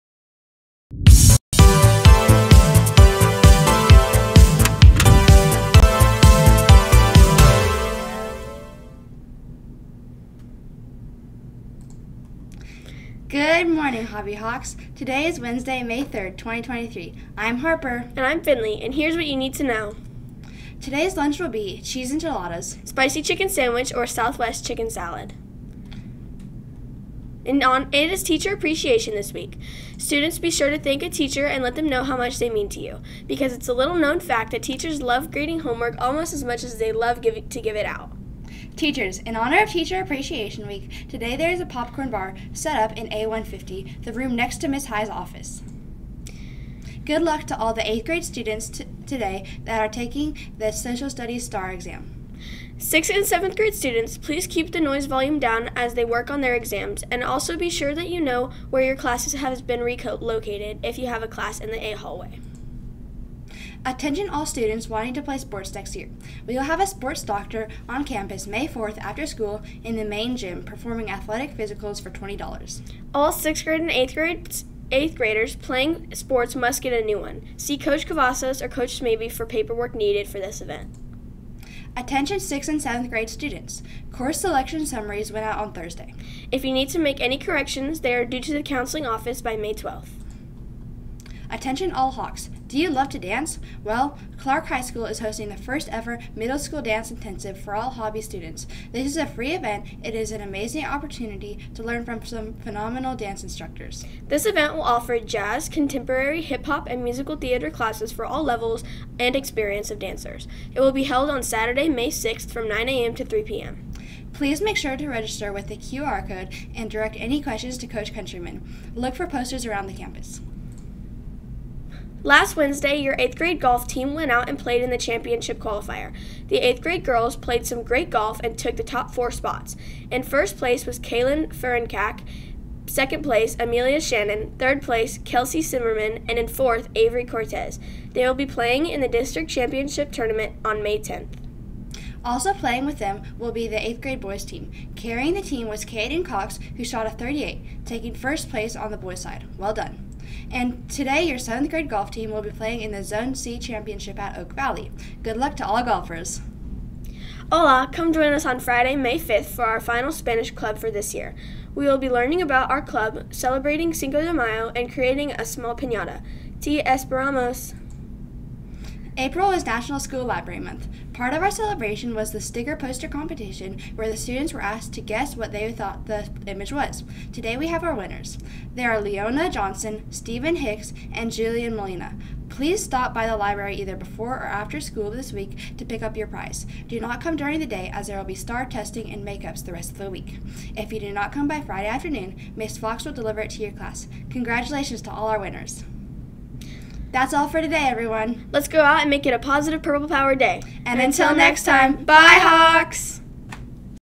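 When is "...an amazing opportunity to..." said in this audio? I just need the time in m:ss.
1:40.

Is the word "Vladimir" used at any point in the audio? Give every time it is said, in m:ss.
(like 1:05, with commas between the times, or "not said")
not said.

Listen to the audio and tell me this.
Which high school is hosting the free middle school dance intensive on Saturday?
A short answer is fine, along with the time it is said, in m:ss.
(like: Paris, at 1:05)
Clark High School, at 1:34.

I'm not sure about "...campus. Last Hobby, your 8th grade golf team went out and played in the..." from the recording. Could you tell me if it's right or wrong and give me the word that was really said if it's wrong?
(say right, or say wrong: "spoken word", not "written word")
wrong: "Wednesday", not "Hobby".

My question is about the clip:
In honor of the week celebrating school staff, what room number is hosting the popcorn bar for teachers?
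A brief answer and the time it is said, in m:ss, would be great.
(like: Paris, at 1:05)
A150, at 0:43.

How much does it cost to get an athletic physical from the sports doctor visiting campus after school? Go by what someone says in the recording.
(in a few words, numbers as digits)
$20.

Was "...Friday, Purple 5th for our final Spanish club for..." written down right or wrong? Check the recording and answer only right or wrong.
wrong.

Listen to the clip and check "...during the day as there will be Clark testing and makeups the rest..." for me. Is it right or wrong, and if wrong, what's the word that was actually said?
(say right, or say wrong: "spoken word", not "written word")
wrong: "STAAR", not "Clark".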